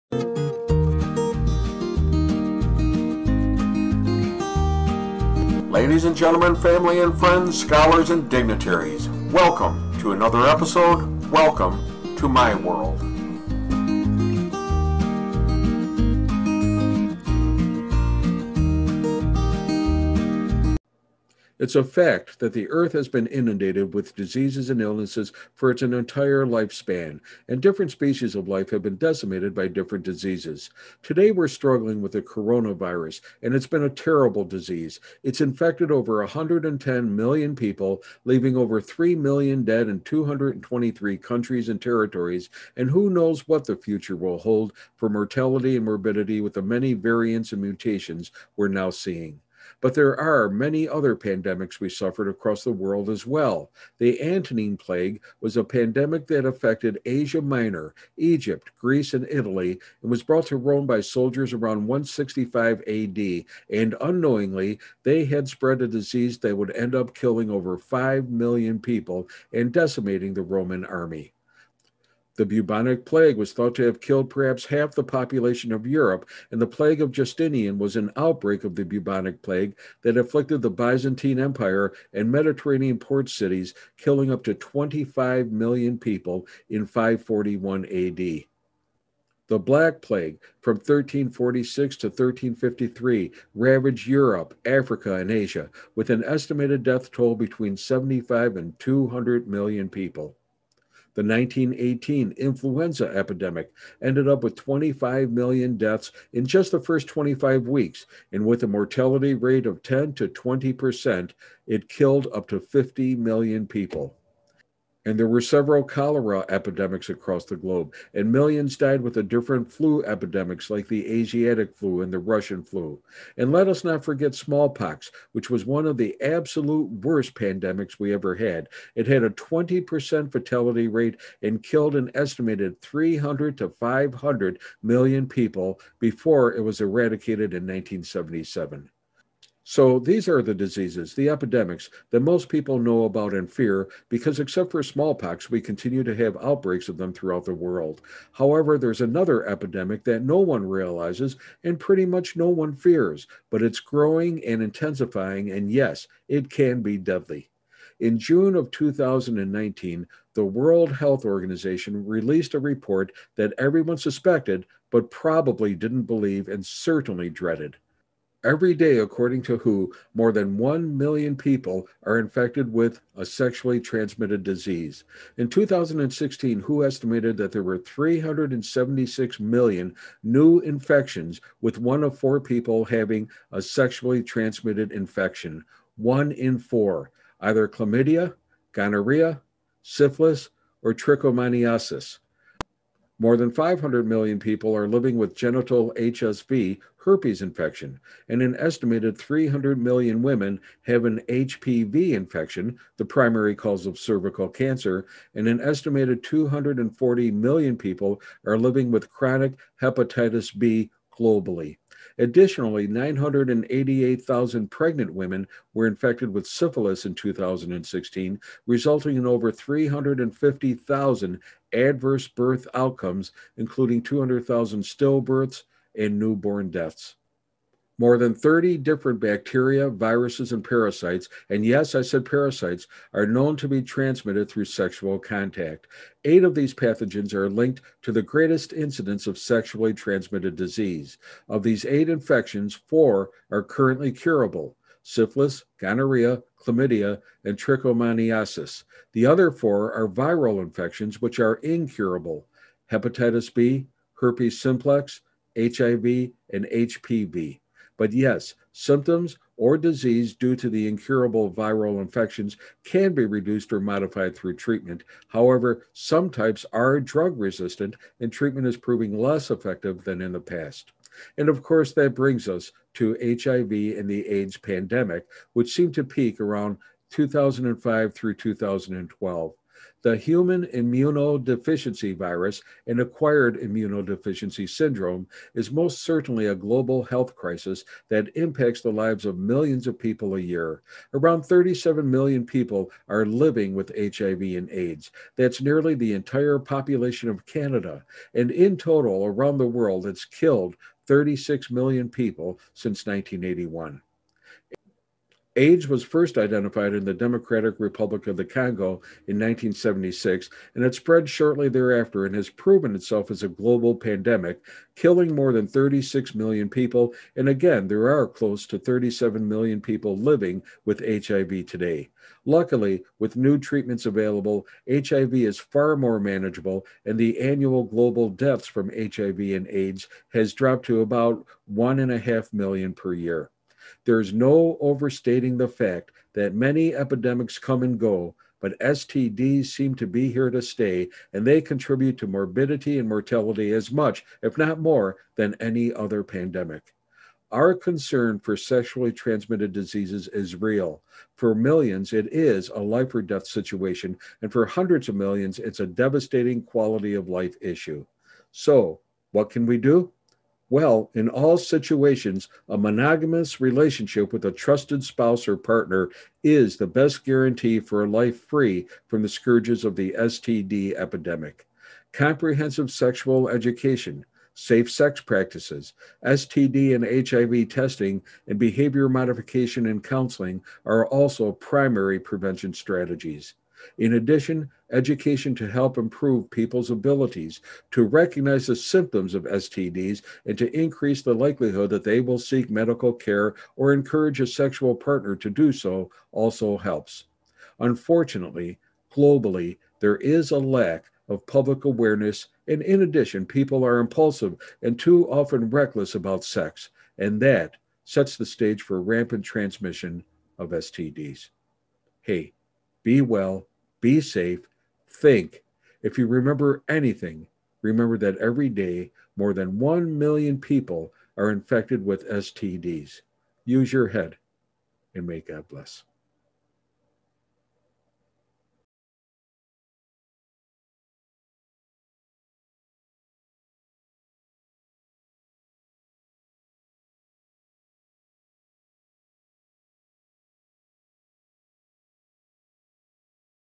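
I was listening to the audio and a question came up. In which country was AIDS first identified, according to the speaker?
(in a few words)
Democratic Republic of the Congo.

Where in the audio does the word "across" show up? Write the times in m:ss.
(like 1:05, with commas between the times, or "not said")
0:52, 1:57.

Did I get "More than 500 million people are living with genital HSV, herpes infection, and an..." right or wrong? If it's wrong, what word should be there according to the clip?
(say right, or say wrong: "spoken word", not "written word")
right.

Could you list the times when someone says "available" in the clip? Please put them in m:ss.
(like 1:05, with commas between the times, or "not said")
5:24.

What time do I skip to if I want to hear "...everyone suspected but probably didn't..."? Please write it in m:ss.
2:43.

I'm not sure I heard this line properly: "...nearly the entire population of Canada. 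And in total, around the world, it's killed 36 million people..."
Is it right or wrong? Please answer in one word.
right.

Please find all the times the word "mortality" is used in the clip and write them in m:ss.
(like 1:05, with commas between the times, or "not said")
0:45, 1:48, 5:43.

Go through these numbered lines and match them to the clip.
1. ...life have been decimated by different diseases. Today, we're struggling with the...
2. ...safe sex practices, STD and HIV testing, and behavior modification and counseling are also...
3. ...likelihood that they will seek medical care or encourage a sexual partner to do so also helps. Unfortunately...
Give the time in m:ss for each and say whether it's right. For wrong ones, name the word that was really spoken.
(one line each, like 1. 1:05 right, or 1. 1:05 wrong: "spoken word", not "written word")
1. 0:28 right
2. 6:14 right
3. 6:31 right.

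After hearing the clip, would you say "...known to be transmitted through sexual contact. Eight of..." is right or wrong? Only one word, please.
right.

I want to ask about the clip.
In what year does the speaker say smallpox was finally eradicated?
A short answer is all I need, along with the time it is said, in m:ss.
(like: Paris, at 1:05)
1977, at 2:17.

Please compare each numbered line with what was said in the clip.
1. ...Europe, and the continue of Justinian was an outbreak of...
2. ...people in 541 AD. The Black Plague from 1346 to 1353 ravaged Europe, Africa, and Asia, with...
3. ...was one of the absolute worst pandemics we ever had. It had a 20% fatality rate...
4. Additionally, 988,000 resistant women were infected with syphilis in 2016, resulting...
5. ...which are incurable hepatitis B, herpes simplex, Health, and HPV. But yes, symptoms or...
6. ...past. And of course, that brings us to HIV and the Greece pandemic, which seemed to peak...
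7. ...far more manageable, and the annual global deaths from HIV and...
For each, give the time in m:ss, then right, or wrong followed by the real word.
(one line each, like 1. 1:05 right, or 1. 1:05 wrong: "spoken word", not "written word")
1. 1:15 wrong: "plague", not "continue"
2. 1:25 right
3. 2:05 right
4. 3:32 wrong: "pregnant", not "resistant"
5. 4:11 wrong: "HIV", not "Health"
6. 4:30 wrong: "AIDS", not "Greece"
7. 5:25 right.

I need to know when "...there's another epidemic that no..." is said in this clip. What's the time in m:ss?
2:28.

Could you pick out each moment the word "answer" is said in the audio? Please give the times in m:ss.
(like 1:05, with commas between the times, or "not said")
not said.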